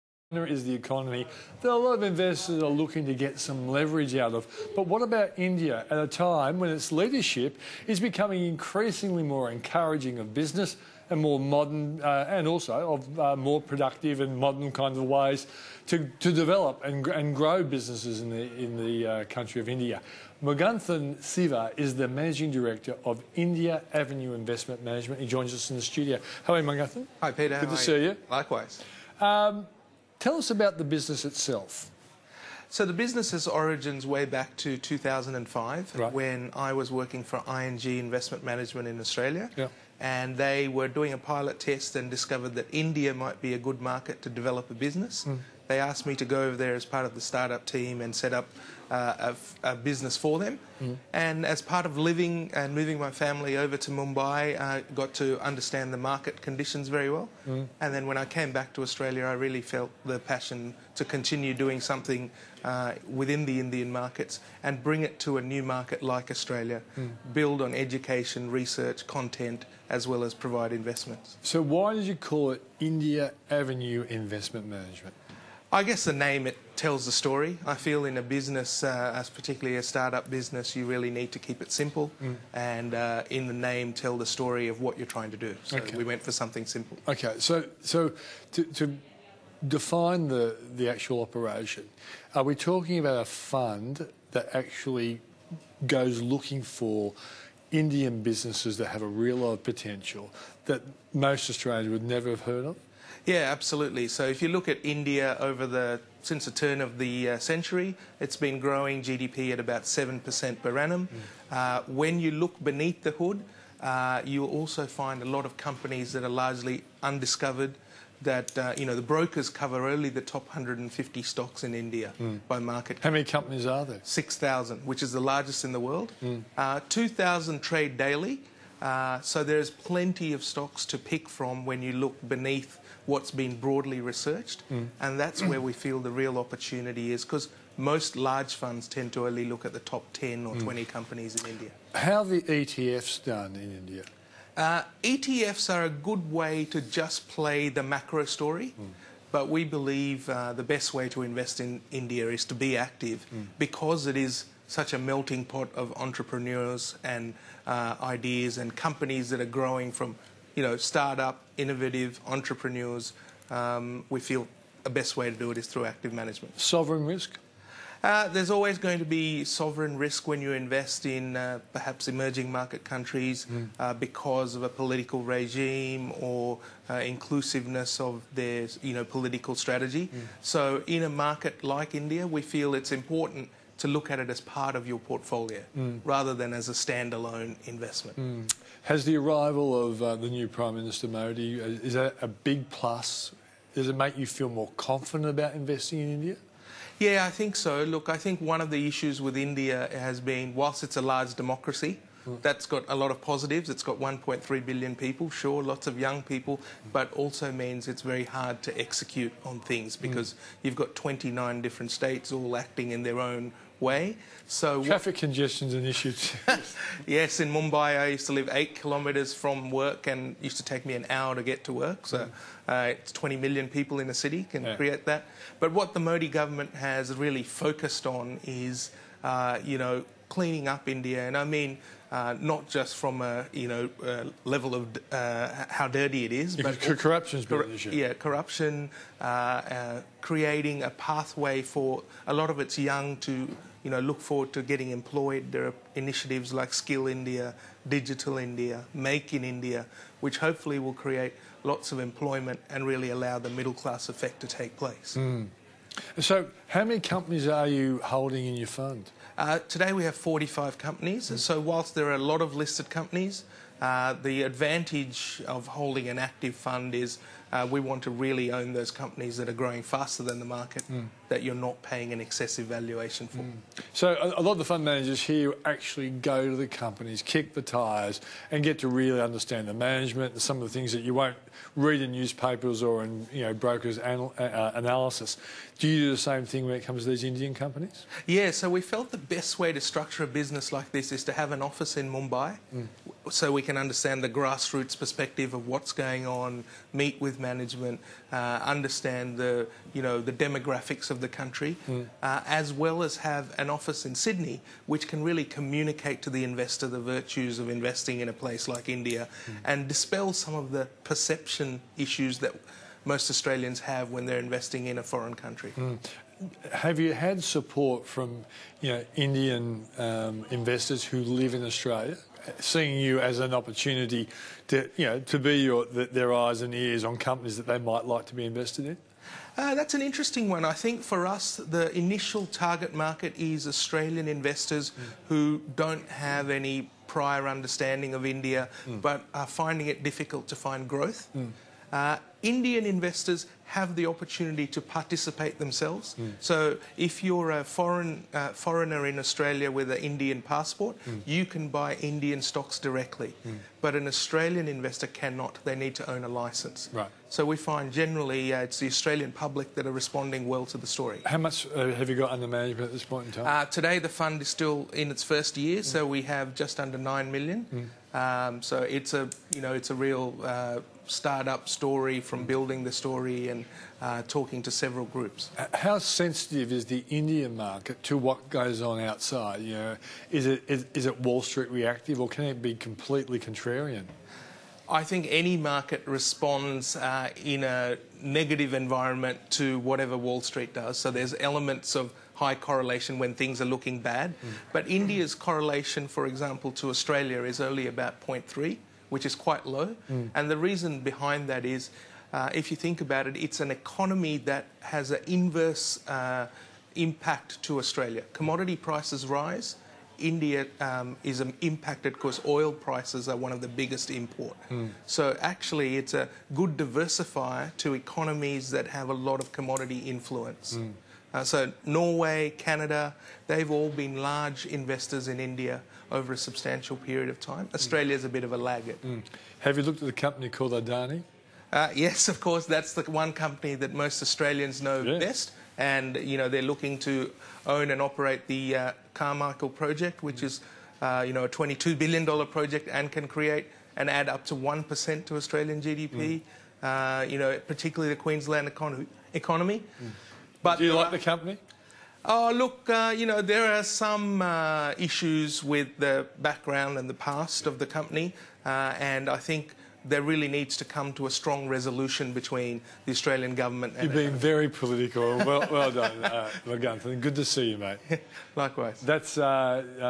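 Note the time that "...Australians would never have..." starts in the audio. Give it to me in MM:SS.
01:41.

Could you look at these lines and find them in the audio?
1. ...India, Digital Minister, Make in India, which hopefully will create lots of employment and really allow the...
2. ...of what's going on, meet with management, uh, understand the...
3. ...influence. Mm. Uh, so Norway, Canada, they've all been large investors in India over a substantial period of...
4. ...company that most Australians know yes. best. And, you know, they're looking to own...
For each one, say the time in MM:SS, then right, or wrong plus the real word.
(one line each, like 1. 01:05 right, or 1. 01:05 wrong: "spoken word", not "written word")
1. 04:07 wrong: "India", not "Minister"
2. 04:55 right
3. 06:59 right
4. 07:13 right.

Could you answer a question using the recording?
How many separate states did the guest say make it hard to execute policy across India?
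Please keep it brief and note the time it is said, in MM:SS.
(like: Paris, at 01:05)
29, at 03:30.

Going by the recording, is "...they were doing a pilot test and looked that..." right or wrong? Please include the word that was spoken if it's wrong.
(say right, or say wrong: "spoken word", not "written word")
wrong: "discovered", not "looked".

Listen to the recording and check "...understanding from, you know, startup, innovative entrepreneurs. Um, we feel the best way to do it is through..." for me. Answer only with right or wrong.
wrong.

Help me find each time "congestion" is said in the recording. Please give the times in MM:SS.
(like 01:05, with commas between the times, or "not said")
03:35.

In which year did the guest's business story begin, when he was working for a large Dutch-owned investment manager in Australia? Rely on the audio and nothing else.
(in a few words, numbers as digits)
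2005.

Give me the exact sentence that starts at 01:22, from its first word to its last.
and uh, in the name, tell the story of what you're trying to do.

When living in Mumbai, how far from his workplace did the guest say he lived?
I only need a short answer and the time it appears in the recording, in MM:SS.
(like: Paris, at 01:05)
8 kilometres, at 03:38.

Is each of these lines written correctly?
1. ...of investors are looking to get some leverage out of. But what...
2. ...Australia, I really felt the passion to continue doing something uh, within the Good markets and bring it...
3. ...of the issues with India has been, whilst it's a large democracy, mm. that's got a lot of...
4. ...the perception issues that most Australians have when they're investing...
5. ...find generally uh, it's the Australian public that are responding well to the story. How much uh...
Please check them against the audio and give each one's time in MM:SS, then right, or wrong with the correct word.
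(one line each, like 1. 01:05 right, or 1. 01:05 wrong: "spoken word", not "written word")
1. 00:01 right
2. 00:58 wrong: "Indian", not "Good"
3. 03:18 right
4. 05:10 right
5. 05:57 right.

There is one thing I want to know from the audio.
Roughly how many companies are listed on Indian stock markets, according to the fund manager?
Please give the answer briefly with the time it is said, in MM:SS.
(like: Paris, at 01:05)
6,000, at 02:04.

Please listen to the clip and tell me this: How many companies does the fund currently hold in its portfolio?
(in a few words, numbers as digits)
45.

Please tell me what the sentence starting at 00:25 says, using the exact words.
He joins us in the studio.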